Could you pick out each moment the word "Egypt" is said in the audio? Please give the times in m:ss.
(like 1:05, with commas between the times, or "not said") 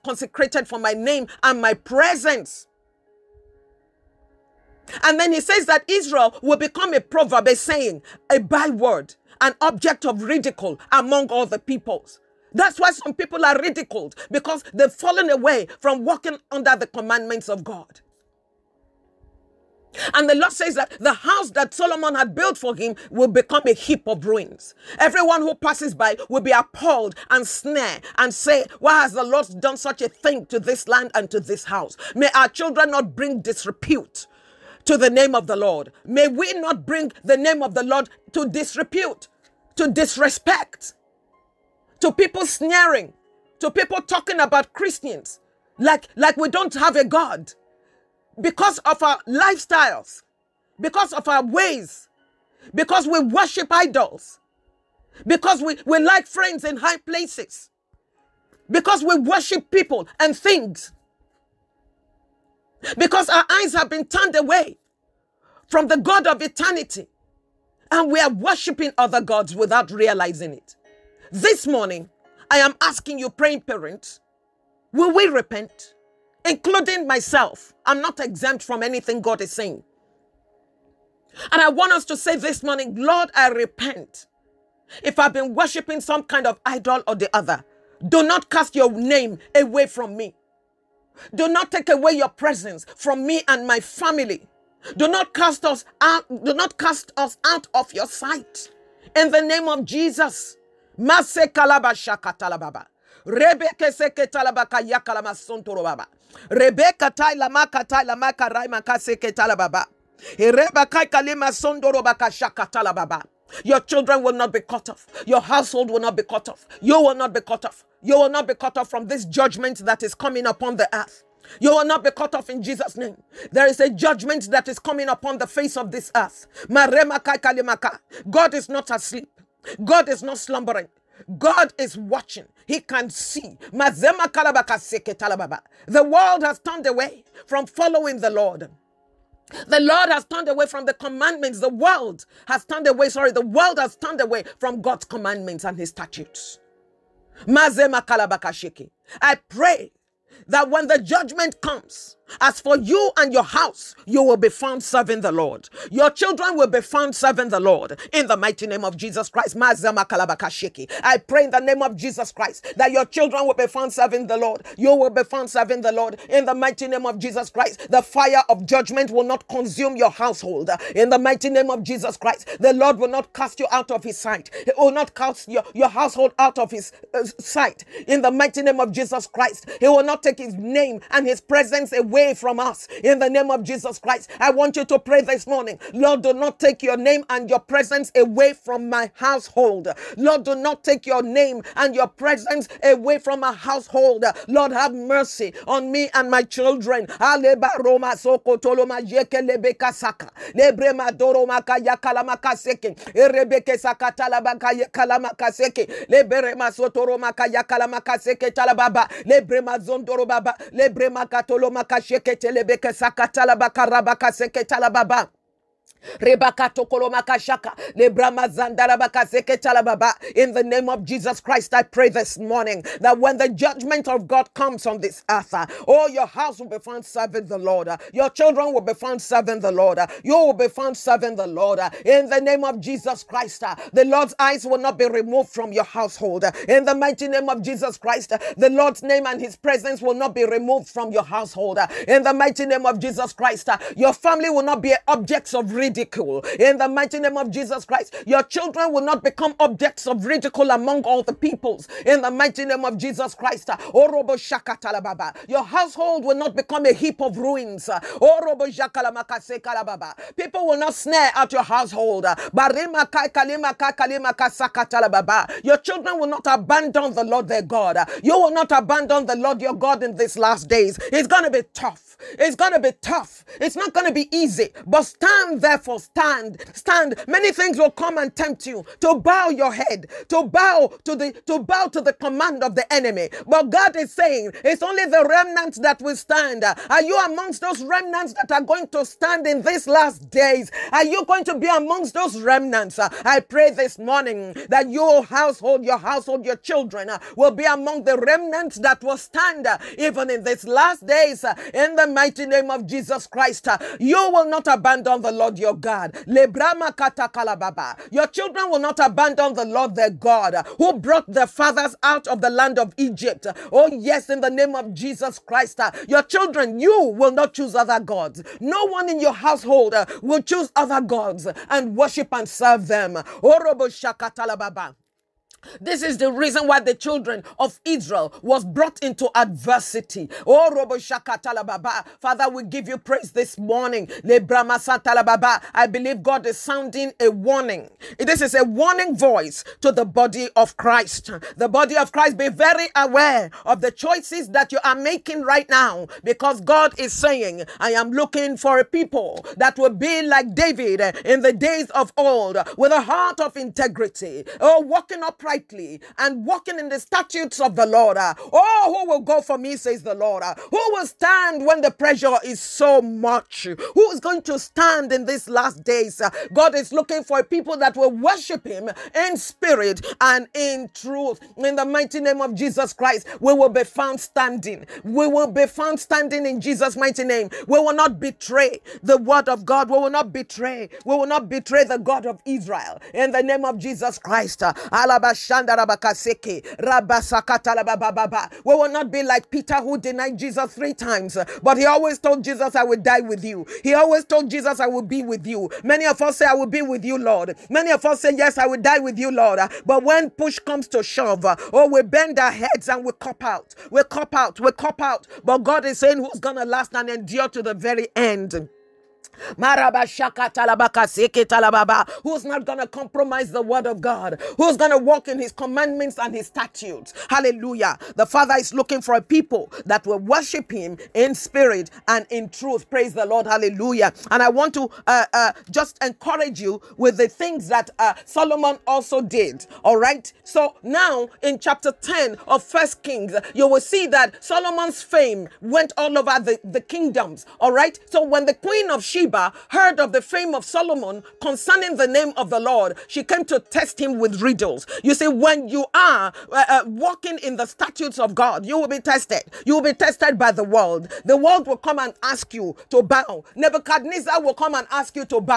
5:12.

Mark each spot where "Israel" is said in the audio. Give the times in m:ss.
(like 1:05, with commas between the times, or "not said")
0:05, 5:27, 6:22.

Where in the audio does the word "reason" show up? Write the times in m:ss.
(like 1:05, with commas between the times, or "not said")
4:05, 5:26.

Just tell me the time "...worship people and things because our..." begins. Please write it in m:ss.
0:59.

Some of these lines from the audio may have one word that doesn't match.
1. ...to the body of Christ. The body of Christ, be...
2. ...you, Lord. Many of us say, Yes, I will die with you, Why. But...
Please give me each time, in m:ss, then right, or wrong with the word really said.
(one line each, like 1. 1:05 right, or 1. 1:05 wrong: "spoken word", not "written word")
1. 5:39 right
2. 6:37 wrong: "Lord", not "Why".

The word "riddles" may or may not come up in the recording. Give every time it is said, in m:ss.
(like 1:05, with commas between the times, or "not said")
7:24.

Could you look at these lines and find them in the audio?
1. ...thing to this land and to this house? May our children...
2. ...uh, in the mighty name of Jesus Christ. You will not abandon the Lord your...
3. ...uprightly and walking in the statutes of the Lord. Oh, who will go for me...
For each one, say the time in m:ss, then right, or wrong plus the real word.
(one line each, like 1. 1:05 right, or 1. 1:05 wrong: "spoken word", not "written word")
1. 0:30 right
2. 5:01 right
3. 5:55 right.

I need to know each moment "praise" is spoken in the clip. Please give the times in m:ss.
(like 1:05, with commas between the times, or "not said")
5:32, 7:02.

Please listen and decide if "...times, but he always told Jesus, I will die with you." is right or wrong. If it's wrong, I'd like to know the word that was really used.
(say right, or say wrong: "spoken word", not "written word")
right.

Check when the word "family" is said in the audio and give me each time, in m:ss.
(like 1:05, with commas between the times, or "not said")
1:33, 4:04.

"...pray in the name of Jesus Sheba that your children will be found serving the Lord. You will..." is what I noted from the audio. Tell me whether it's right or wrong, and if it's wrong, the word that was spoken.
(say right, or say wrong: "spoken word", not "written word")
wrong: "Christ", not "Sheba".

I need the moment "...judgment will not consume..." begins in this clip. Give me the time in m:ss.
2:48.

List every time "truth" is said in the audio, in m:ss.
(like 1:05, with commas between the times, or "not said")
6:10, 7:02.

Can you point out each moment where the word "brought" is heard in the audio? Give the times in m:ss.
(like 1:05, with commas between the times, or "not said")
5:10, 5:28.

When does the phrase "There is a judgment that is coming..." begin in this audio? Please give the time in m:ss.
2:03.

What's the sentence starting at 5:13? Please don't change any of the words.
Oh, yes, in the name of Jesus Christ.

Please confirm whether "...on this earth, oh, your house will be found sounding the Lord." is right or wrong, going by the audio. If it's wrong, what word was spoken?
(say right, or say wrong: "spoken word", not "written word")
wrong: "serving", not "sounding".